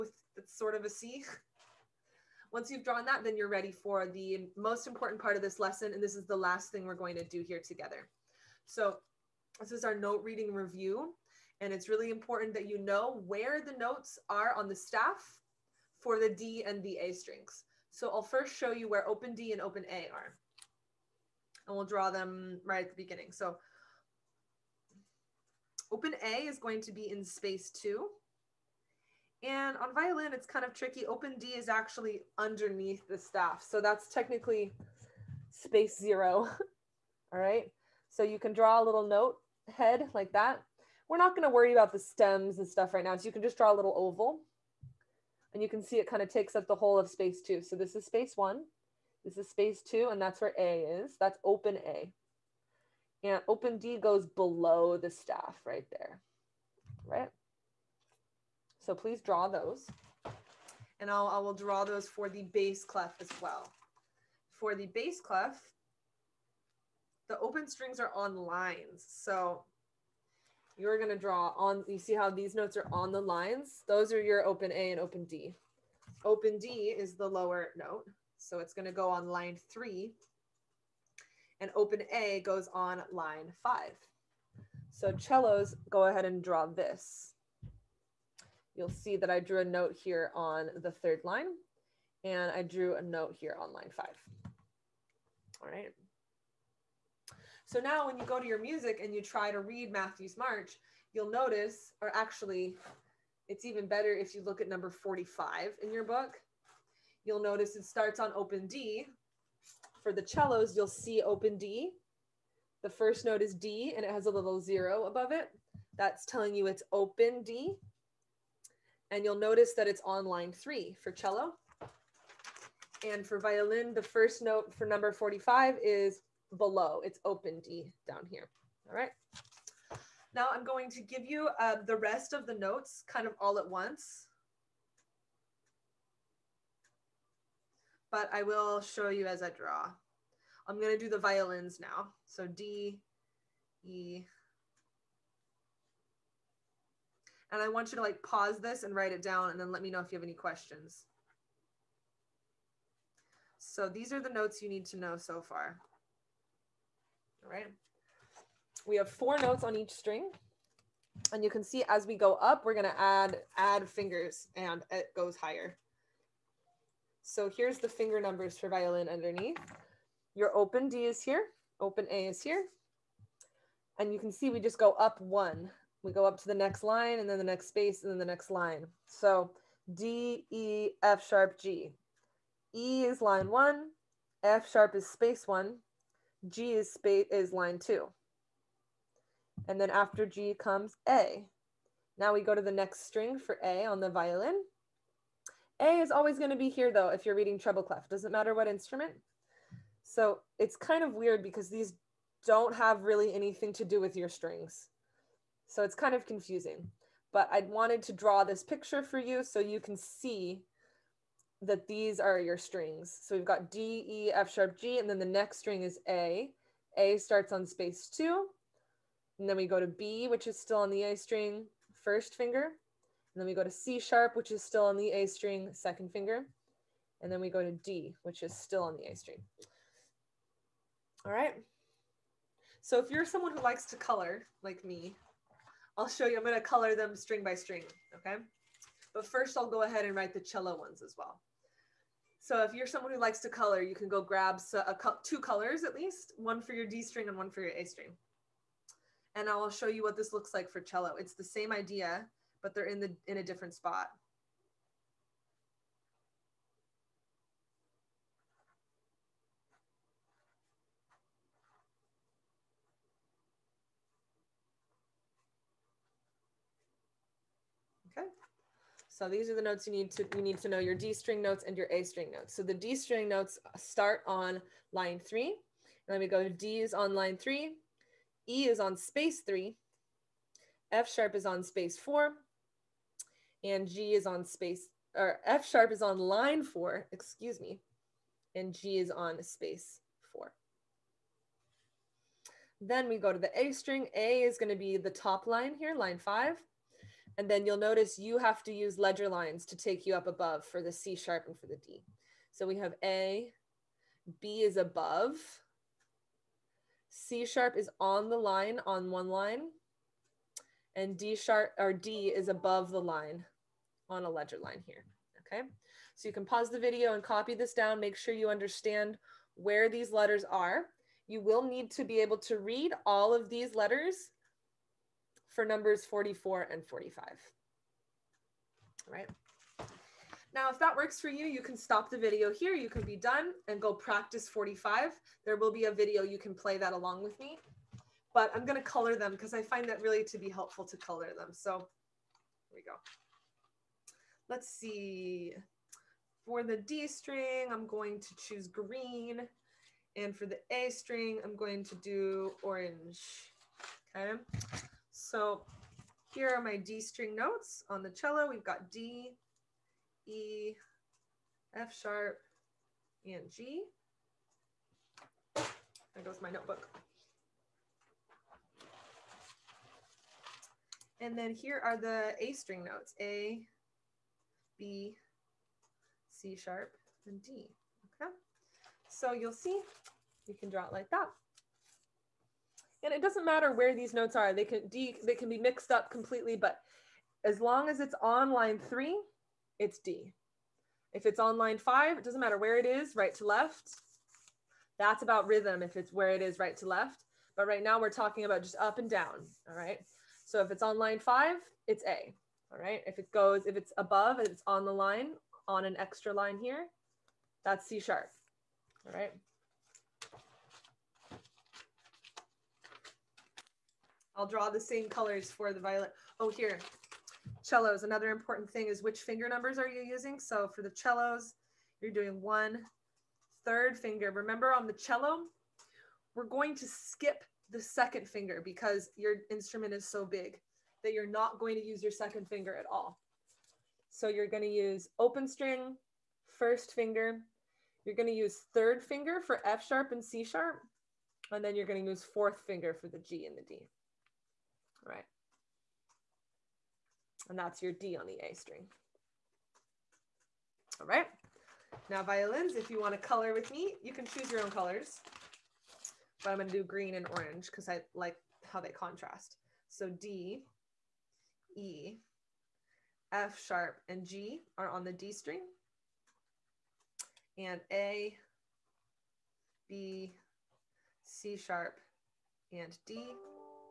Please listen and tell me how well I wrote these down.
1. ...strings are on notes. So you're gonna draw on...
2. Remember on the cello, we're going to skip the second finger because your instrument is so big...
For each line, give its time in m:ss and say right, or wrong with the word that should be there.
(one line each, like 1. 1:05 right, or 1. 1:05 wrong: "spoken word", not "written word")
1. 1:07 wrong: "lines", not "notes"
2. 7:04 right.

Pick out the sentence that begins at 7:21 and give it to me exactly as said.
And then you're going to use fourth finger for the G and the D.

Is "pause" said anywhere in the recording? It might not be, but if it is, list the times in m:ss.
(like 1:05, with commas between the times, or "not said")
2:28, 5:16.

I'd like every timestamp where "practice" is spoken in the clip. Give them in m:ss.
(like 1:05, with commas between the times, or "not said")
5:33.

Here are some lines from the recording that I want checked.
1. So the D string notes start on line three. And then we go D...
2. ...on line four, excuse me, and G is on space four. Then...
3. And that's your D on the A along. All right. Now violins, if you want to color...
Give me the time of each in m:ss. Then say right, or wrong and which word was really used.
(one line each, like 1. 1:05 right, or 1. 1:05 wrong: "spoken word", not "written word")
1. 4:32 right
2. 4:46 right
3. 7:27 wrong: "string", not "along".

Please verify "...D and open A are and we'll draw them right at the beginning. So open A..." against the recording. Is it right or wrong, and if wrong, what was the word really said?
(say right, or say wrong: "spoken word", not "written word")
right.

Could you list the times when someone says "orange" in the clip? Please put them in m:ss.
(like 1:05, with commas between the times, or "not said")
5:52, 7:37.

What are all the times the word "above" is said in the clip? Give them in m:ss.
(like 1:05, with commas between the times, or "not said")
1:55, 5:00, 5:04, 5:12, 6:43.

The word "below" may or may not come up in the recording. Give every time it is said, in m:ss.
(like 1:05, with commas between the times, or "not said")
0:54, 2:06.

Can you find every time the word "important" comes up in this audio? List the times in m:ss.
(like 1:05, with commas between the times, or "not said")
0:04, 0:12, 6:58.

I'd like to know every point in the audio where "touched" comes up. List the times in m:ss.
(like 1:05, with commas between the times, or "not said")
not said.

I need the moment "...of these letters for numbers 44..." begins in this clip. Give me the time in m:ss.
5:23.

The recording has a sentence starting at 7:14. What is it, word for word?
So you're going to use open string, first finger.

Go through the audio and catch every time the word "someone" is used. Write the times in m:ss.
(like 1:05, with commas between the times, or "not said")
3:53, 4:02.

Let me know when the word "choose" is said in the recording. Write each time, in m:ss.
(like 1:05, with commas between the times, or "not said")
5:48, 7:34.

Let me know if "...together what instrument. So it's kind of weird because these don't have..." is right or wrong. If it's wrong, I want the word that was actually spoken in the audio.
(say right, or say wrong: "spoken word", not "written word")
wrong: "matter", not "together".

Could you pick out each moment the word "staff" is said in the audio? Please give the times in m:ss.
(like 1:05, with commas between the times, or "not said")
0:14, 0:33, 0:55.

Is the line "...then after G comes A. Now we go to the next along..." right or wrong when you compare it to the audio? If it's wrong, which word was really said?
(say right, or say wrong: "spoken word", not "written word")
wrong: "string", not "along".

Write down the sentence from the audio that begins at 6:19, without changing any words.
So you'll see, you can draw it like that.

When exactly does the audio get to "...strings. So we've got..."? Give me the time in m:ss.
3:32.